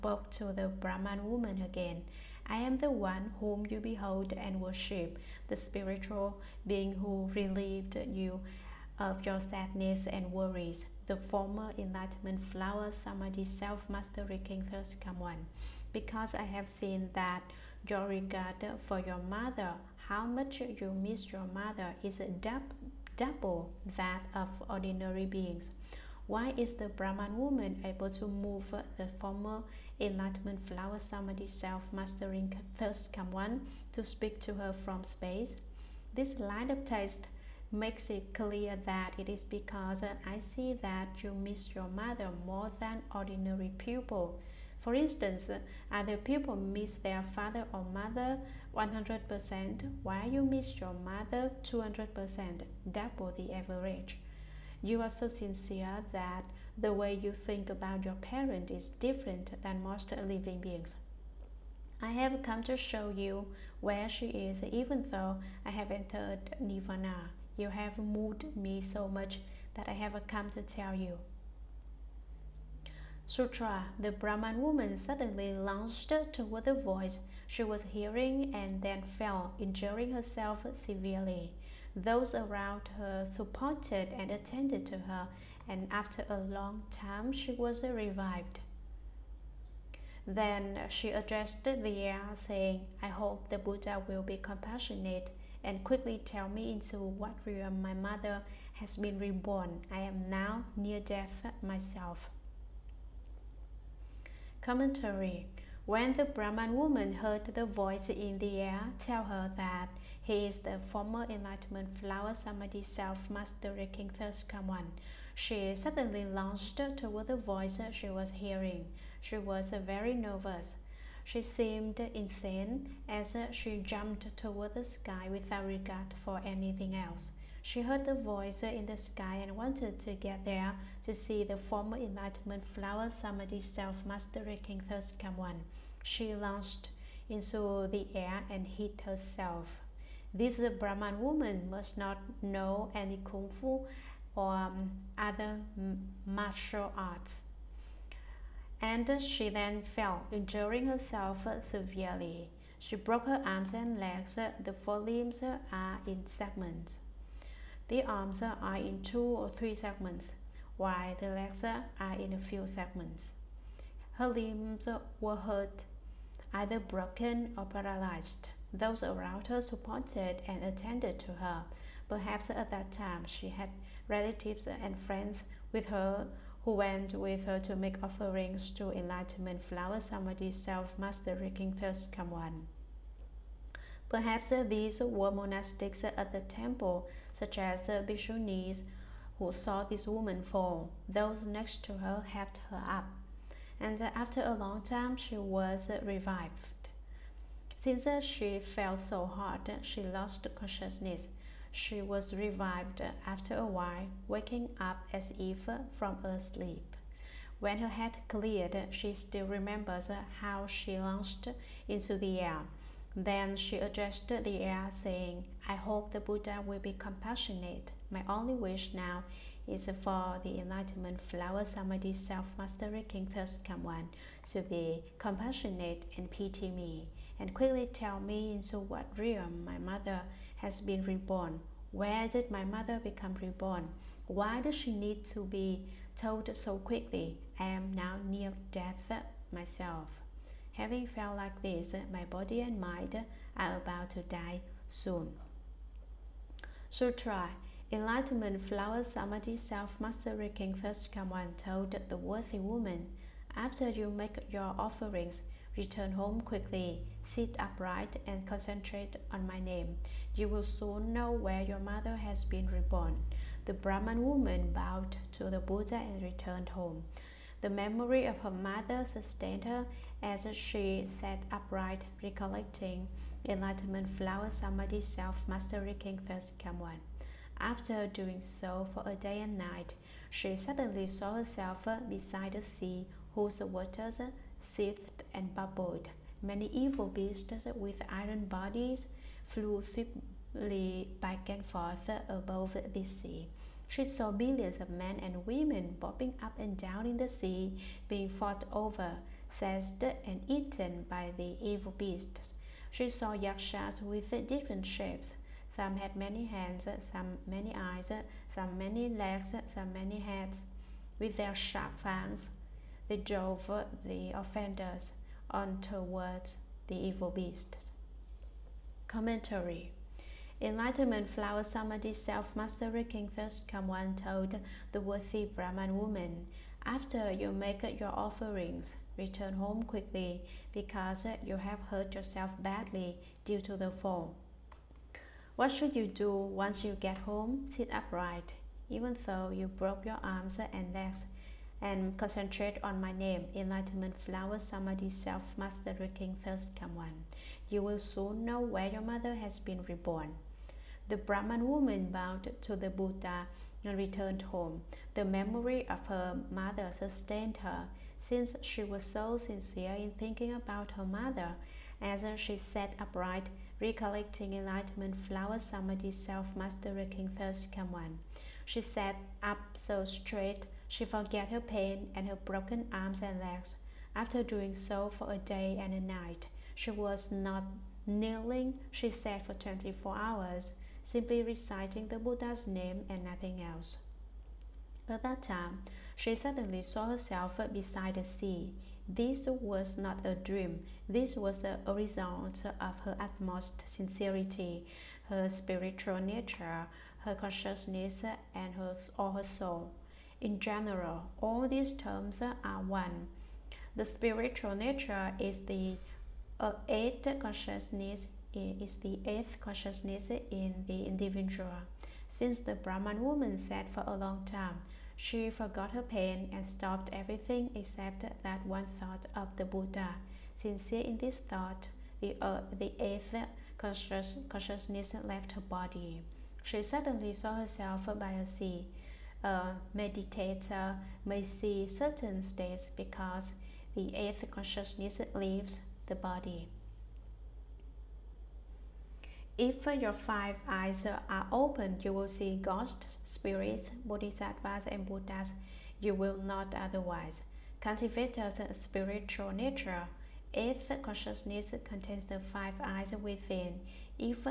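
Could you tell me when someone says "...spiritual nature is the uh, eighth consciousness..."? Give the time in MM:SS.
06:44.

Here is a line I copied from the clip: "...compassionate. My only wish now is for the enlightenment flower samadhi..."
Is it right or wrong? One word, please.
right.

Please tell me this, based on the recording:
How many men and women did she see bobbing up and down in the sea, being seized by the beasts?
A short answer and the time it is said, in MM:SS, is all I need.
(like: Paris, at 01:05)
millions, at 04:54.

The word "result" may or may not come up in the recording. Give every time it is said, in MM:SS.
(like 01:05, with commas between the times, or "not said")
06:31.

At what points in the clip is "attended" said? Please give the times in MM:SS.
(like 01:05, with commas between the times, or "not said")
01:24, 02:50.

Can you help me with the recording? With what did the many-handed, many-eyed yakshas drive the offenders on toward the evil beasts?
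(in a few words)
sharp fangs.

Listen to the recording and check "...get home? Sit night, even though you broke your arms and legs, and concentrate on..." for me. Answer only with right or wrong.
wrong.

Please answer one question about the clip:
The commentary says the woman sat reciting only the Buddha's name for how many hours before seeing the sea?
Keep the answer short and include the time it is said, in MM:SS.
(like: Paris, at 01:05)
24, at 06:19.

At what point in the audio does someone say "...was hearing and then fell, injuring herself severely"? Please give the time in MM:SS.
01:17.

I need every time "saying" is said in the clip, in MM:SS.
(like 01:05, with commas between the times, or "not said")
01:32, 03:34.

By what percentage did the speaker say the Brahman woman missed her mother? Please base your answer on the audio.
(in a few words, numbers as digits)
200%.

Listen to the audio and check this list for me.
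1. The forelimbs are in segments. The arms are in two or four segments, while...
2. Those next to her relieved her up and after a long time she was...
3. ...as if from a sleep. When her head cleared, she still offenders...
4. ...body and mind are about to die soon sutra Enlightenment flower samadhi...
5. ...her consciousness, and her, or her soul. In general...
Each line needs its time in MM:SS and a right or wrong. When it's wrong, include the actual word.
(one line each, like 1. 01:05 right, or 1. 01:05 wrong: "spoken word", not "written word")
1. 02:34 wrong: "three", not "four"
2. 03:11 wrong: "helped", not "relieved"
3. 03:25 wrong: "remembers", not "offenders"
4. 04:02 right
5. 06:37 right.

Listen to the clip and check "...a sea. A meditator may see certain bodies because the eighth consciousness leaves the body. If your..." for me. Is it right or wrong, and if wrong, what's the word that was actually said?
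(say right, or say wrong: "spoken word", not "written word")
wrong: "states", not "bodies".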